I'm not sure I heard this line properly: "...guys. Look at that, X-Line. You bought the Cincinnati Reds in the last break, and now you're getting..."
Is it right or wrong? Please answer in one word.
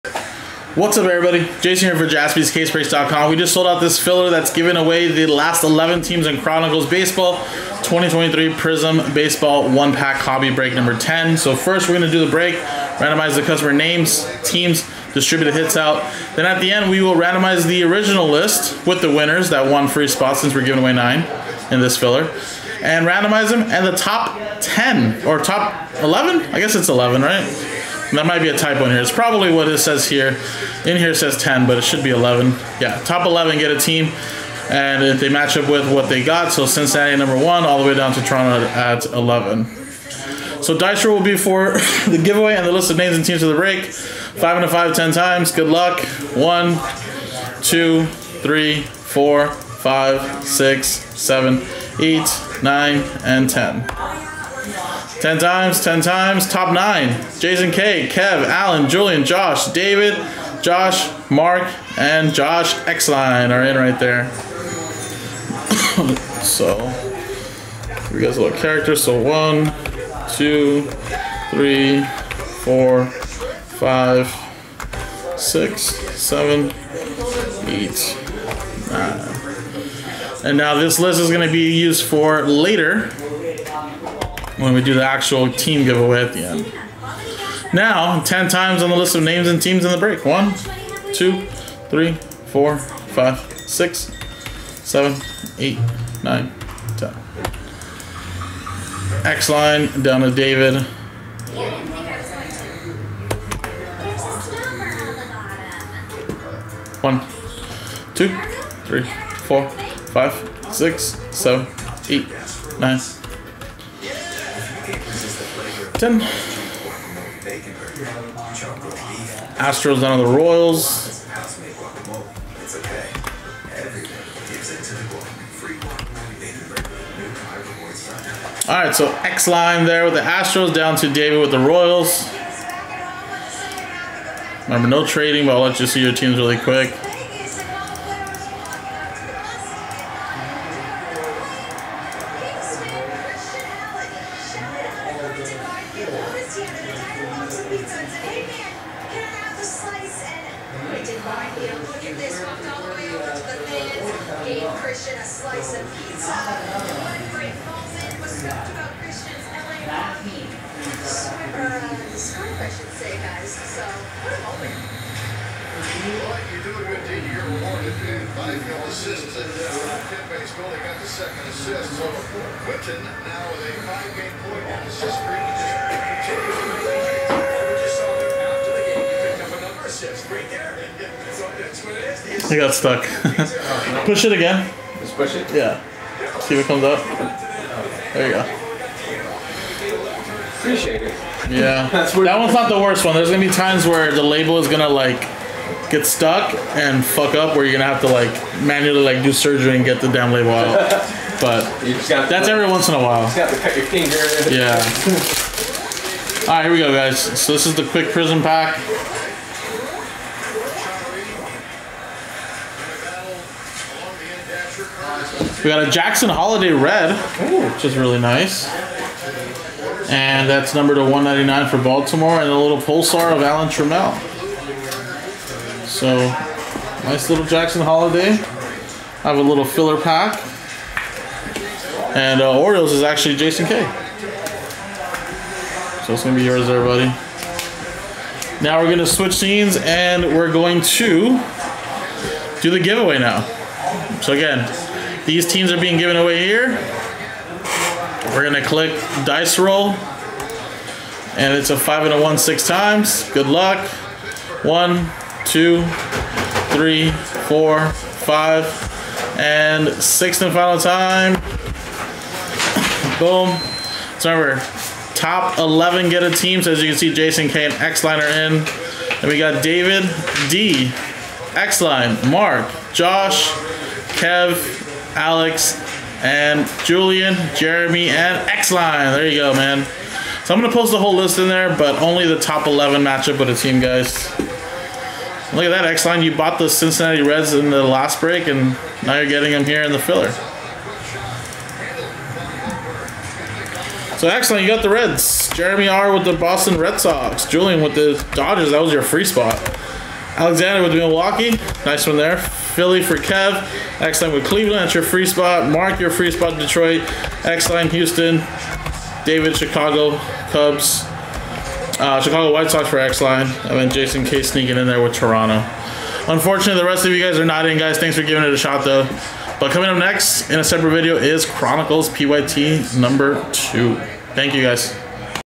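right.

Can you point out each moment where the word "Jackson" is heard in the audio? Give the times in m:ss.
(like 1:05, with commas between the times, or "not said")
3:35, 3:47.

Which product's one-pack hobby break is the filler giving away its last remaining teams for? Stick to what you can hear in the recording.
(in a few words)
Chronicles Baseball 2023 Prizm.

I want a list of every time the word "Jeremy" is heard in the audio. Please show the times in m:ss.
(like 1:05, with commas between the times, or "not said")
4:37, 4:55.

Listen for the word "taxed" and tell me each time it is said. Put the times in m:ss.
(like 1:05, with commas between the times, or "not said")
not said.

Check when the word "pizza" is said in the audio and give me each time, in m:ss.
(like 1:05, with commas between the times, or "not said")
2:27, 2:35.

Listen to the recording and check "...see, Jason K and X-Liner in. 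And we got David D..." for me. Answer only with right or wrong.
right.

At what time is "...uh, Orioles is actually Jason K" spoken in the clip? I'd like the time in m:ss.
3:52.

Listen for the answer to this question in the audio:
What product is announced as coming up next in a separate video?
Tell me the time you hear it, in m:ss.
5:21.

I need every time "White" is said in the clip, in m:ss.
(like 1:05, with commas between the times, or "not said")
5:12.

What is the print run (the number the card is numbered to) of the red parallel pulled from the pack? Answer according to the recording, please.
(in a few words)
199.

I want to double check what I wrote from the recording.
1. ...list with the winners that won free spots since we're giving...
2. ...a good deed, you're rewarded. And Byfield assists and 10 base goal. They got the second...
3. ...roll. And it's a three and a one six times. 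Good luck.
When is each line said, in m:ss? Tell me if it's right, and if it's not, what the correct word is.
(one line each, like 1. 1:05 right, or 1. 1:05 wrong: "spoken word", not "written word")
1. 0:18 right
2. 2:46 right
3. 4:09 wrong: "five", not "three".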